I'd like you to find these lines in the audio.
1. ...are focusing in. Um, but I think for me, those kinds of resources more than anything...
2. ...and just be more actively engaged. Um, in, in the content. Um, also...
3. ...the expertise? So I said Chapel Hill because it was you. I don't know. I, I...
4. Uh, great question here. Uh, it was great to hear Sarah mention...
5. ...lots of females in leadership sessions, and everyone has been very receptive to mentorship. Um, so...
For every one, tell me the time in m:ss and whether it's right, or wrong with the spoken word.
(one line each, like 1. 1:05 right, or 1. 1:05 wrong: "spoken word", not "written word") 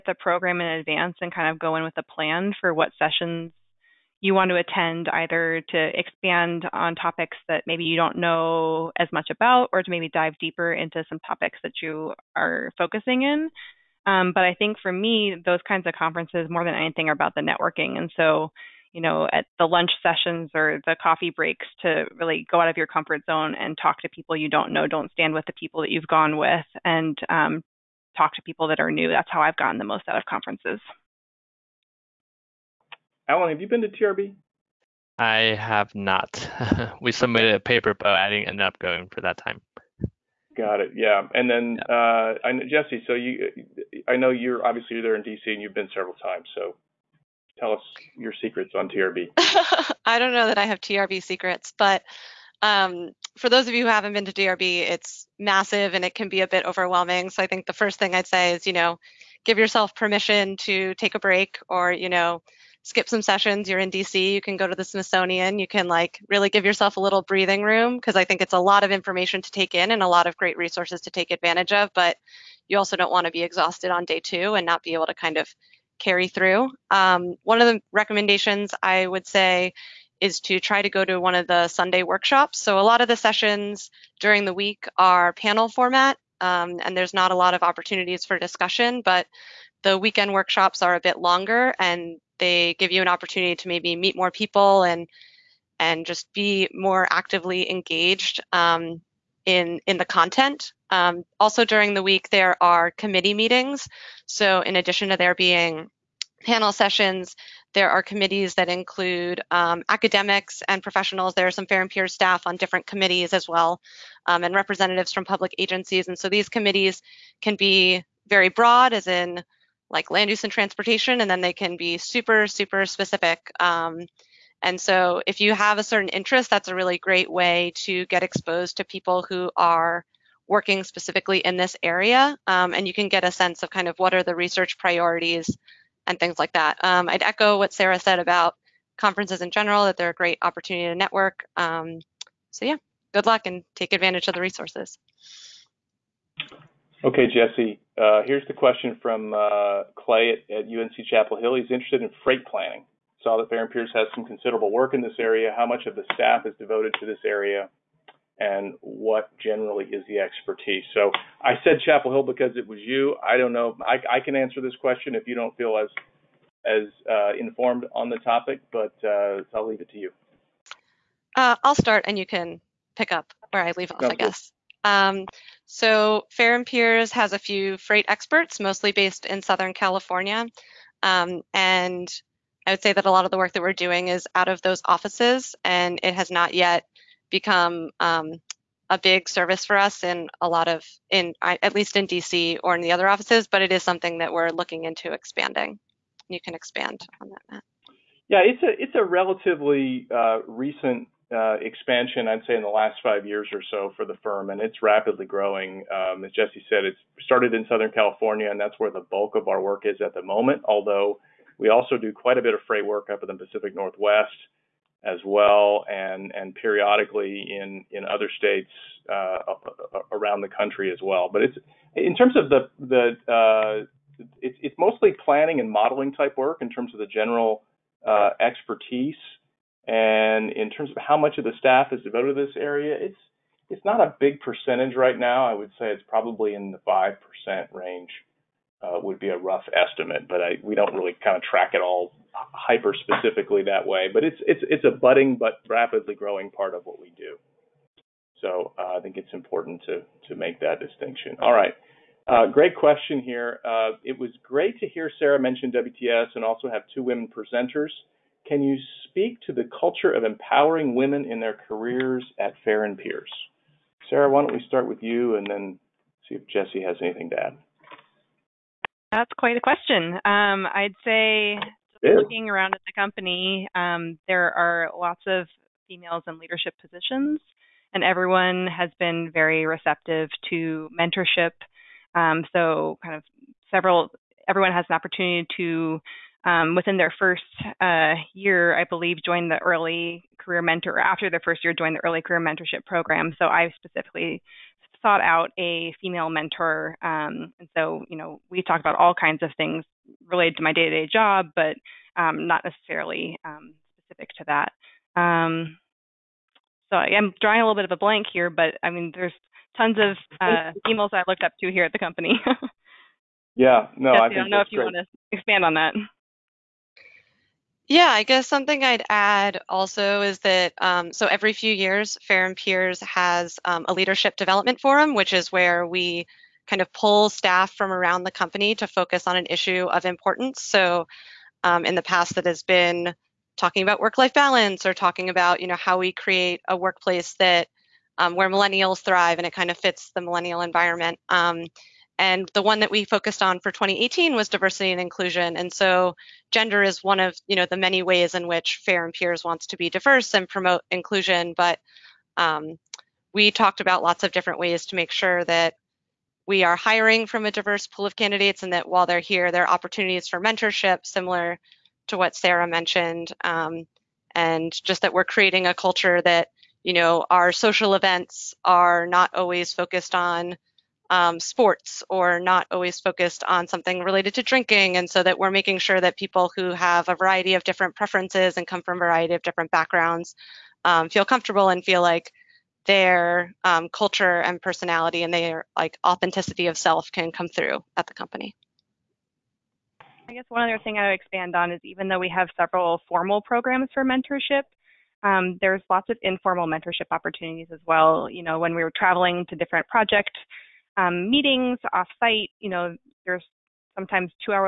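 1. 0:12 wrong: "conferences", not "resources"
2. 1:35 right
3. 2:40 right
4. 4:12 right
5. 4:34 wrong: "positions", not "sessions".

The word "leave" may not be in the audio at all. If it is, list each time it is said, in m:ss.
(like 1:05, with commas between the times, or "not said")
2:49, 2:53.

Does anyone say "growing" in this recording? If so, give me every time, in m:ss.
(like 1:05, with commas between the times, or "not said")
3:25, 4:06.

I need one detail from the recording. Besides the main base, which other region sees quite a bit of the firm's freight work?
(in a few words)
Pacific Northwest.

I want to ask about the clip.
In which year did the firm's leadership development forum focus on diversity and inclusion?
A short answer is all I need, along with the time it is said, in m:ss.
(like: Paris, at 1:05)
2018, at 5:43.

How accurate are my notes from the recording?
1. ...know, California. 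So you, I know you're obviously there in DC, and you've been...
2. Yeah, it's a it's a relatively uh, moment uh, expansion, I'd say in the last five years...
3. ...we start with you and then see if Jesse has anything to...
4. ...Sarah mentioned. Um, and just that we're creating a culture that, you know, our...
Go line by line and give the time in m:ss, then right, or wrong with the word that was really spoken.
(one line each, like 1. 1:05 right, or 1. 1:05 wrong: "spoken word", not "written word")
1. 0:42 wrong: "Jesse", not "California"
2. 3:18 wrong: "recent", not "moment"
3. 4:24 right
4. 6:02 right.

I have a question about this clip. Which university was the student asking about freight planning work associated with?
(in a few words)
UNC Chapel Hill.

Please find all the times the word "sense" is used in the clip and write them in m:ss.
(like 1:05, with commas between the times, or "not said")
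2:13.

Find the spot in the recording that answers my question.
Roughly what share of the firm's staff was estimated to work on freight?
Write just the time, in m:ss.
3:56.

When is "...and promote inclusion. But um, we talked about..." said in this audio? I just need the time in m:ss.
5:50.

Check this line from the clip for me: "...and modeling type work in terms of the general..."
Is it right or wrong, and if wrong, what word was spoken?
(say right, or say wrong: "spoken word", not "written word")
right.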